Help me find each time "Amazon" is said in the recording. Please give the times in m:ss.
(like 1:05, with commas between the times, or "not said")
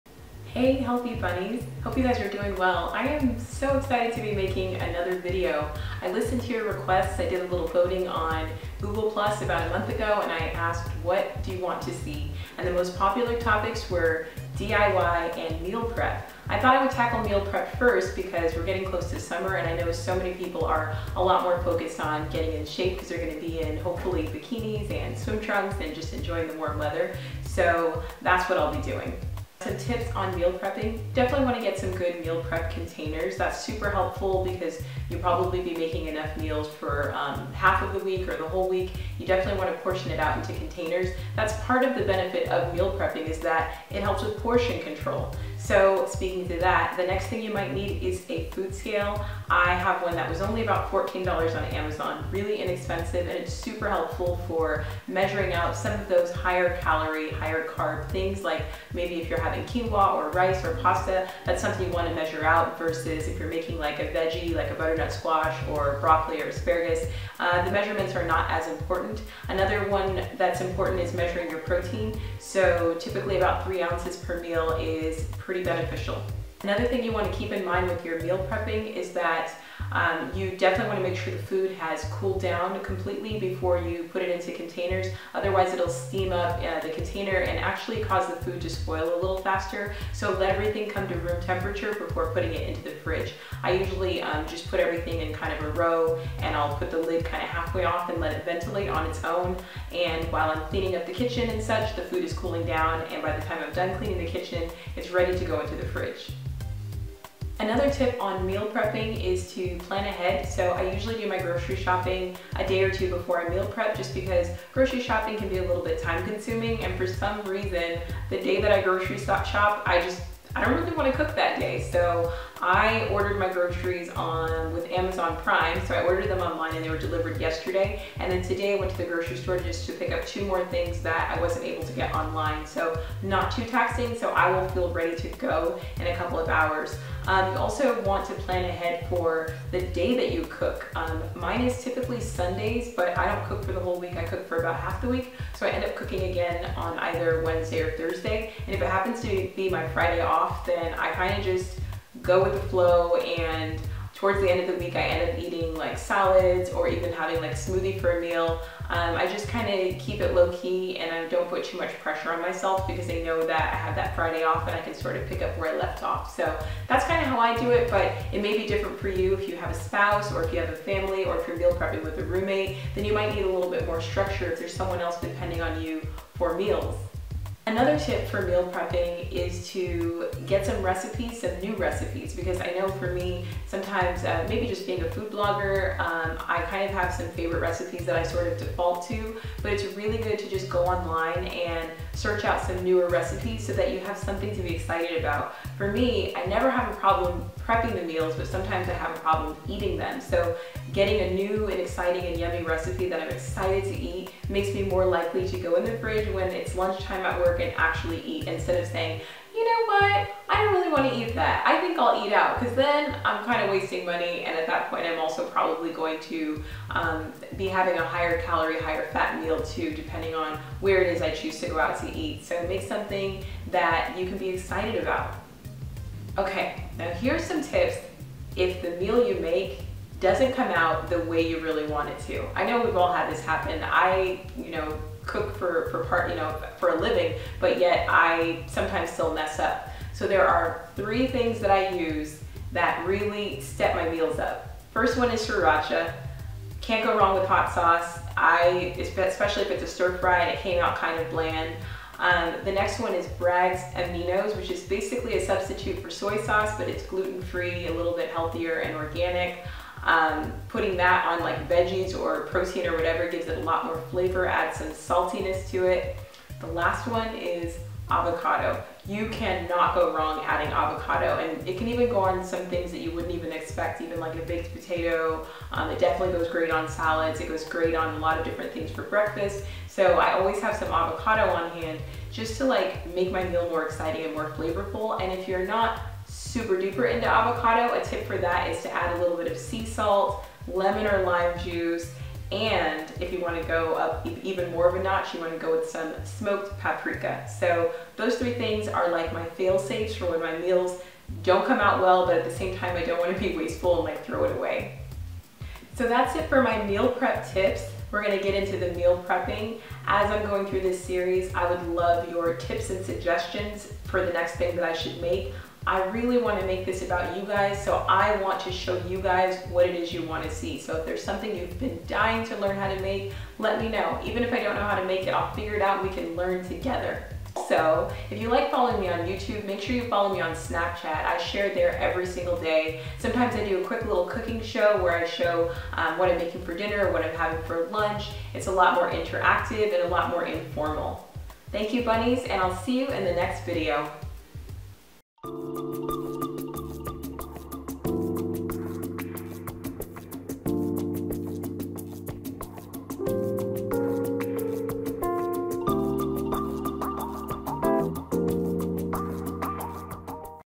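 0:51, 2:04.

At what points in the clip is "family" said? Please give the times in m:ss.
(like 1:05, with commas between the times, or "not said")
2:50.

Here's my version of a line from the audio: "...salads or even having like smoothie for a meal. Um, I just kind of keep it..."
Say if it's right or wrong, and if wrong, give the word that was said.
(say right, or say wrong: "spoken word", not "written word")
right.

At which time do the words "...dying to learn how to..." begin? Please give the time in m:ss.
5:22.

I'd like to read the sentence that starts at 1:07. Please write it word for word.
Uh, the measurements are not as important.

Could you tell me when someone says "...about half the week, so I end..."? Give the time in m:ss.
2:24.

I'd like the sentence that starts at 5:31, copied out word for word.
I share there every single day.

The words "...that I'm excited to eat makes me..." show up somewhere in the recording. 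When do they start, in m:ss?
3:23.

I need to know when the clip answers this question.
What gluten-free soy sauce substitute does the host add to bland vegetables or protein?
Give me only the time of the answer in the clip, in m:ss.
4:13.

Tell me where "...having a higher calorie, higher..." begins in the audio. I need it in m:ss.
3:37.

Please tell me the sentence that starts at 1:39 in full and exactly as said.
And while I'm cleaning up the kitchen and such, the food is cooling down.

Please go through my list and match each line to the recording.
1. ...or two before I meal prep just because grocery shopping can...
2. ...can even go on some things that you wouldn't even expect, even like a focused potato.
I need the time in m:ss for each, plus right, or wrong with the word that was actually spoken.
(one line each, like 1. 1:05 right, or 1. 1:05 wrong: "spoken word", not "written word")
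1. 1:52 right
2. 4:31 wrong: "baked", not "focused".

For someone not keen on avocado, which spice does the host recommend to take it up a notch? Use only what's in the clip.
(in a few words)
smoked paprika.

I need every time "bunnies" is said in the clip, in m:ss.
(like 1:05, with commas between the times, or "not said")
0:01, 5:42.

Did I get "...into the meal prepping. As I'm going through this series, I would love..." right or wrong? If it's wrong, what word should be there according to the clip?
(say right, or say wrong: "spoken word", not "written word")
right.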